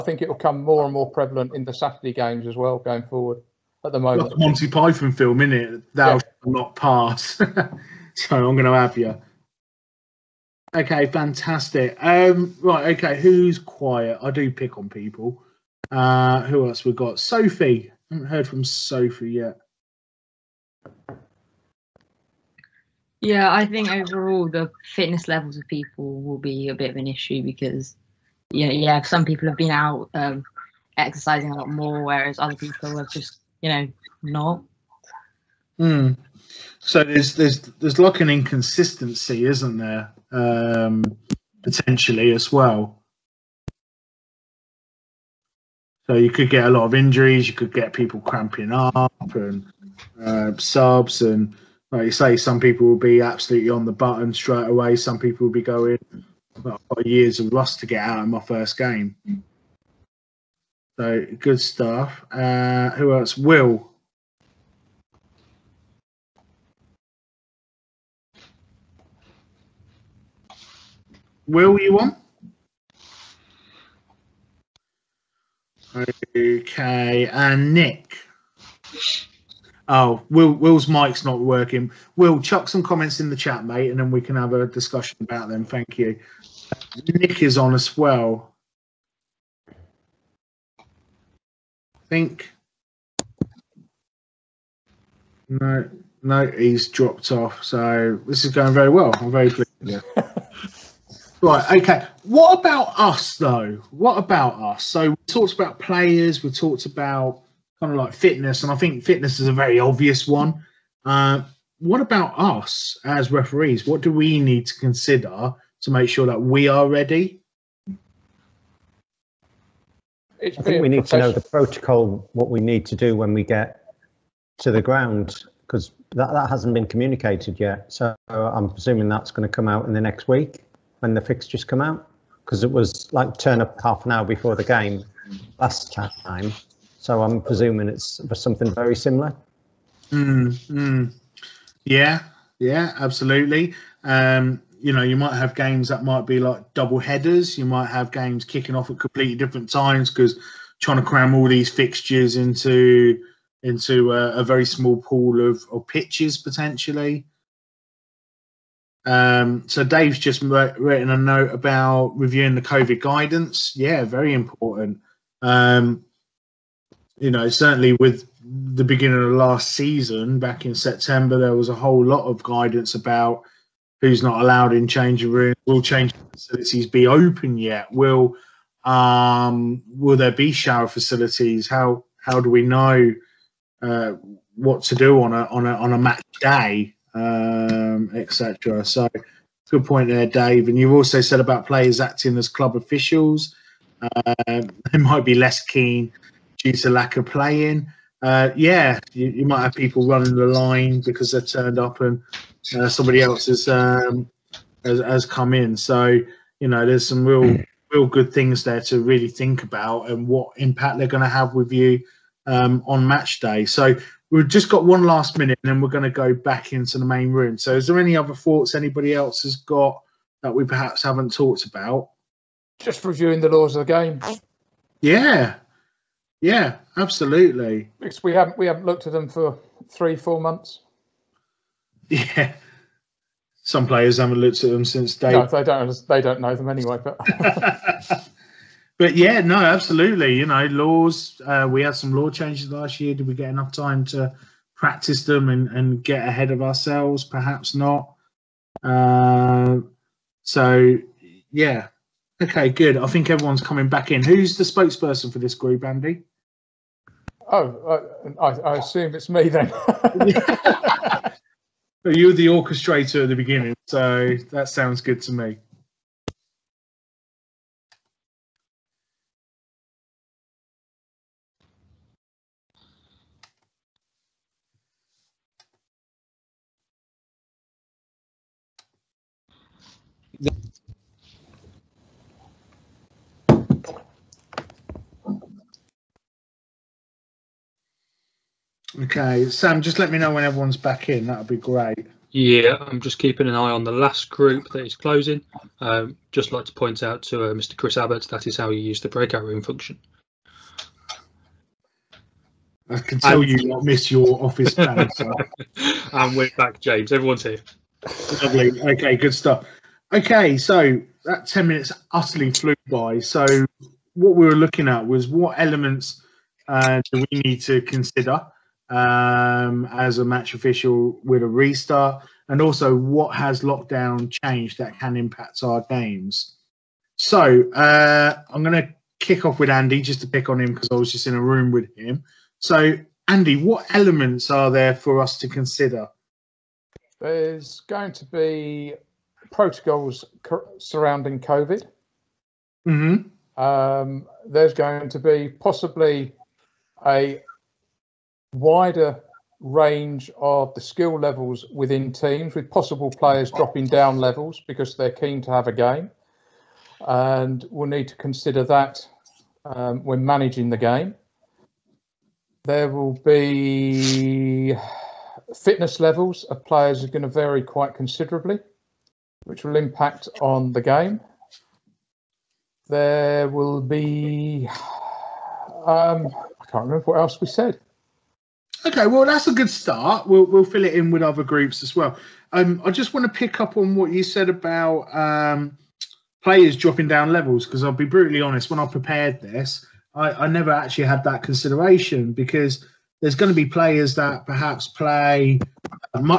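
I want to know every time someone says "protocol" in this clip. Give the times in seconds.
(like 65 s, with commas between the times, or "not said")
121 s, 339 s.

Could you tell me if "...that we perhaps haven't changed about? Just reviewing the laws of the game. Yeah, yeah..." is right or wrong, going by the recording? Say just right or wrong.
wrong.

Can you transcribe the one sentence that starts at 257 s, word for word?
Oh, uh, I, I assume it's me then.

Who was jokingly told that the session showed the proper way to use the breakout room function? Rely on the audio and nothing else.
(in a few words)
Chris Abbott.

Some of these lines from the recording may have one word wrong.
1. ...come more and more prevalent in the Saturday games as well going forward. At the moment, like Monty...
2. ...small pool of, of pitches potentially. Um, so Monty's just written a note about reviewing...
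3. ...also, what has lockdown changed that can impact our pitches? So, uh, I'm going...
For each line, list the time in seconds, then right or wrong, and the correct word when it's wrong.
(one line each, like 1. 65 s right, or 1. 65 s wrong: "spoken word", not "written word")
1. 0 s right
2. 154 s wrong: "Dave", not "Monty"
3. 322 s wrong: "games", not "pitches".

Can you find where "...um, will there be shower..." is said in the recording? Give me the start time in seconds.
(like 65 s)
178 s.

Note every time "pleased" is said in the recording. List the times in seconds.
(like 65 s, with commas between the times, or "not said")
99 s.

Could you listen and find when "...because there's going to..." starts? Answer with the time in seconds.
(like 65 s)
392 s.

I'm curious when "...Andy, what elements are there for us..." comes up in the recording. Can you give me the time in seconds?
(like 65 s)
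333 s.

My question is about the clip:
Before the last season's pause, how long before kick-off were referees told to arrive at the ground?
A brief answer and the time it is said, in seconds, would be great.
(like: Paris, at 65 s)
half an hour, at 133 s.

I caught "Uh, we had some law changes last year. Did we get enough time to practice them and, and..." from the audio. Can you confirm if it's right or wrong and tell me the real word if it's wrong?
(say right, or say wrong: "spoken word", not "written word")
right.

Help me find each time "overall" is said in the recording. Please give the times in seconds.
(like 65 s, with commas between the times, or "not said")
23 s.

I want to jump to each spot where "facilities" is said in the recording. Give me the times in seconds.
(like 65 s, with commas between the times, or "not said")
176 s, 180 s.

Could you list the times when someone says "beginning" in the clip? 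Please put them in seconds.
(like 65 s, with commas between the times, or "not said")
168 s, 263 s.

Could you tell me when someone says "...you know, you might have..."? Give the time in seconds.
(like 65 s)
144 s.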